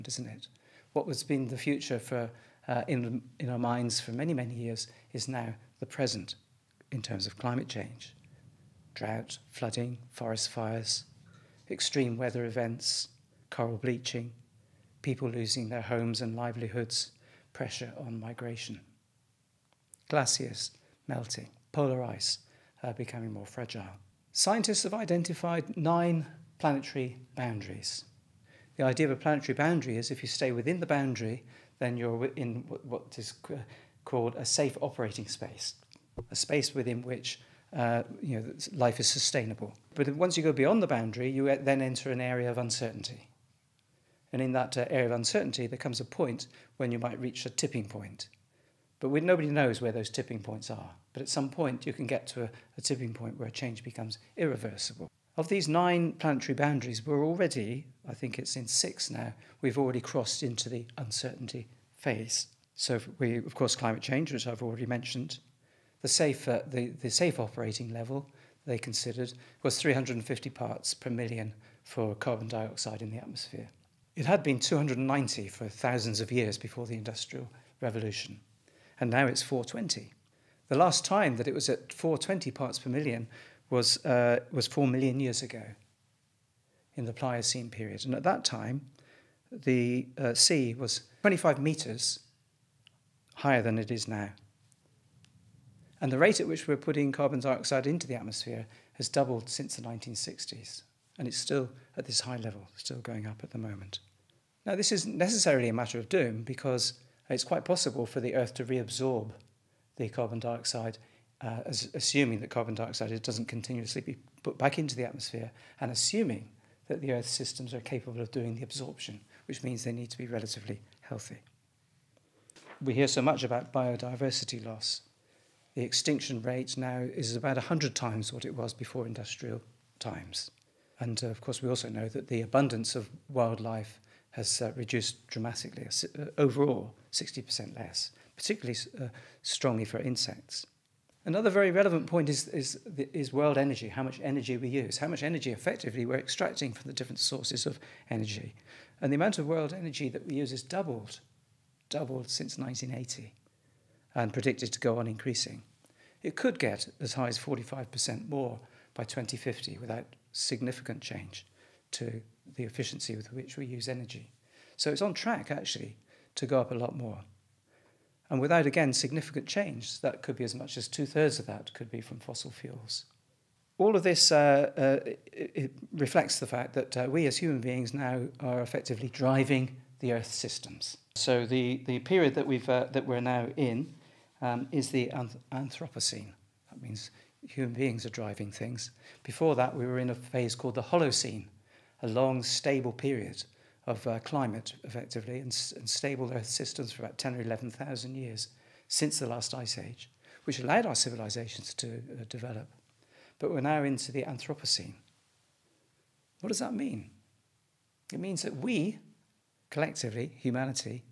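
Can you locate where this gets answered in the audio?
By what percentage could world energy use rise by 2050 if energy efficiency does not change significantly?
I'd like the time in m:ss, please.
2:37.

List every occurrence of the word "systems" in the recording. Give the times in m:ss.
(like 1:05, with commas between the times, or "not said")
1:57, 3:00, 3:16.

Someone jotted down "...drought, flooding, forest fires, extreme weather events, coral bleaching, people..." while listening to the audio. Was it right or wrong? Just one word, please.
right.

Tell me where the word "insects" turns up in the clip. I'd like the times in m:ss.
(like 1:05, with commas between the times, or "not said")
2:19.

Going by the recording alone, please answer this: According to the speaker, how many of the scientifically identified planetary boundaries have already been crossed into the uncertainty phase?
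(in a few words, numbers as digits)
6.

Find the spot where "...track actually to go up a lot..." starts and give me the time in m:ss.
2:45.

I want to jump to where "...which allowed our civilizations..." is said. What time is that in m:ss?
3:20.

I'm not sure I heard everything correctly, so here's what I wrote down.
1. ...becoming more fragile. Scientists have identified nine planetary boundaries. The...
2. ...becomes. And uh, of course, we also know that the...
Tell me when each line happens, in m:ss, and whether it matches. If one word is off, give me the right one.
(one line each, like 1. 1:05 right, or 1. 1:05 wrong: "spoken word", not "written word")
1. 0:22 right
2. 2:09 wrong: "times", not "becomes".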